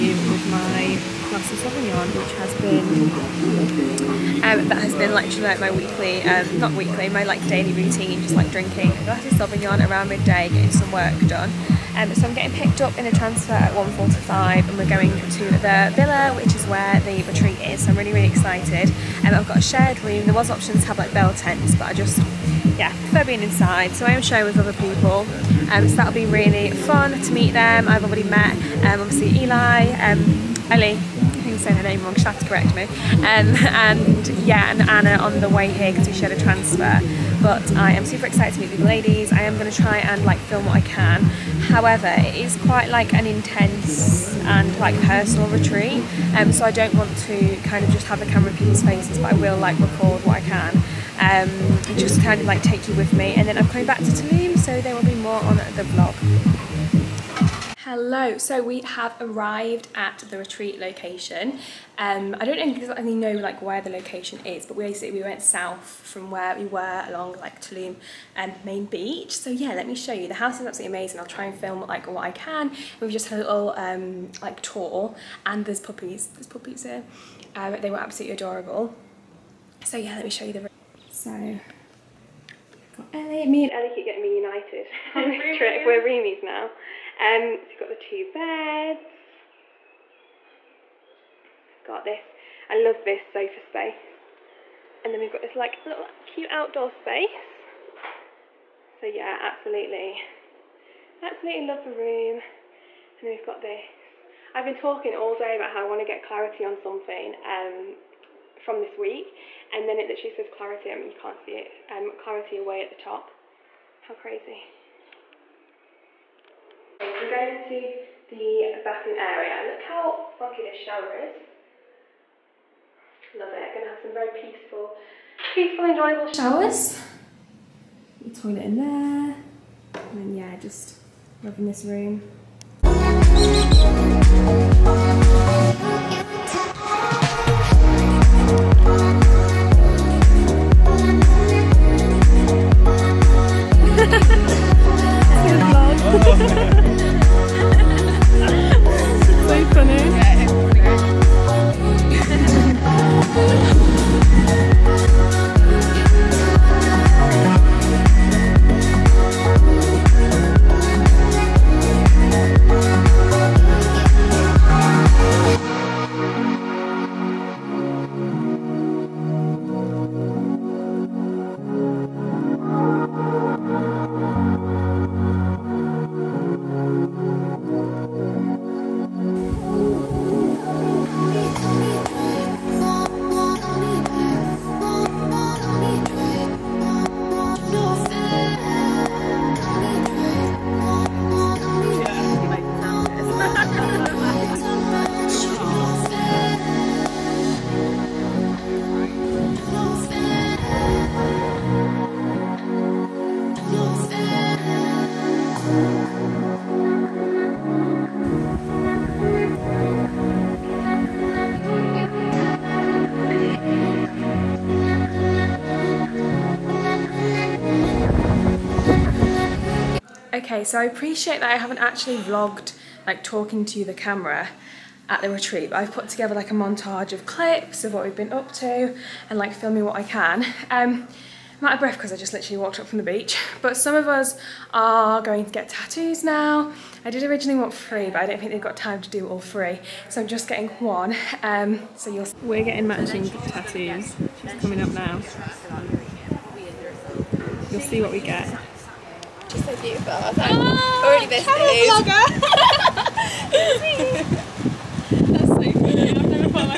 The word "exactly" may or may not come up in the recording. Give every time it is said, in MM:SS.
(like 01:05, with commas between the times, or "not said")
01:02.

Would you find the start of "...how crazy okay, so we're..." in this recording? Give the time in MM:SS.
01:54.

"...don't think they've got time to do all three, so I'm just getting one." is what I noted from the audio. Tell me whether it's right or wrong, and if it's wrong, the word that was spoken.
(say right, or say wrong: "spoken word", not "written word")
right.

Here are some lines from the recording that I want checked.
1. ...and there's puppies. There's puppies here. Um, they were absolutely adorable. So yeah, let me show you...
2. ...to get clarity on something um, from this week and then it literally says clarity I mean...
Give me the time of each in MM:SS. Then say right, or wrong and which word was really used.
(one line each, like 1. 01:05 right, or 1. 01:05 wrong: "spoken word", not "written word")
1. 01:15 right
2. 01:45 right.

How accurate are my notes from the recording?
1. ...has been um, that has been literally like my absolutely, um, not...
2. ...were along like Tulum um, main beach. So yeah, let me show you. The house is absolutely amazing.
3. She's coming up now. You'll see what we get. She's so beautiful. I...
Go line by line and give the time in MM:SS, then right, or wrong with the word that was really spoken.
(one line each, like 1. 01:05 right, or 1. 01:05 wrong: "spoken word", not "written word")
1. 00:02 wrong: "weekly", not "absolutely"
2. 01:06 right
3. 04:04 right.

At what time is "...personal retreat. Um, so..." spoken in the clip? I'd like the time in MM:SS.
00:45.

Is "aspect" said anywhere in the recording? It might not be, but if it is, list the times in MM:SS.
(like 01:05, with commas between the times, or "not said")
not said.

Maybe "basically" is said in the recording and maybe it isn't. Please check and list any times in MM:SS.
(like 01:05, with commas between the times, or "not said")
01:04.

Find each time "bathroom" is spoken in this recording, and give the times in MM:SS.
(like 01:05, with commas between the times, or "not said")
01:58.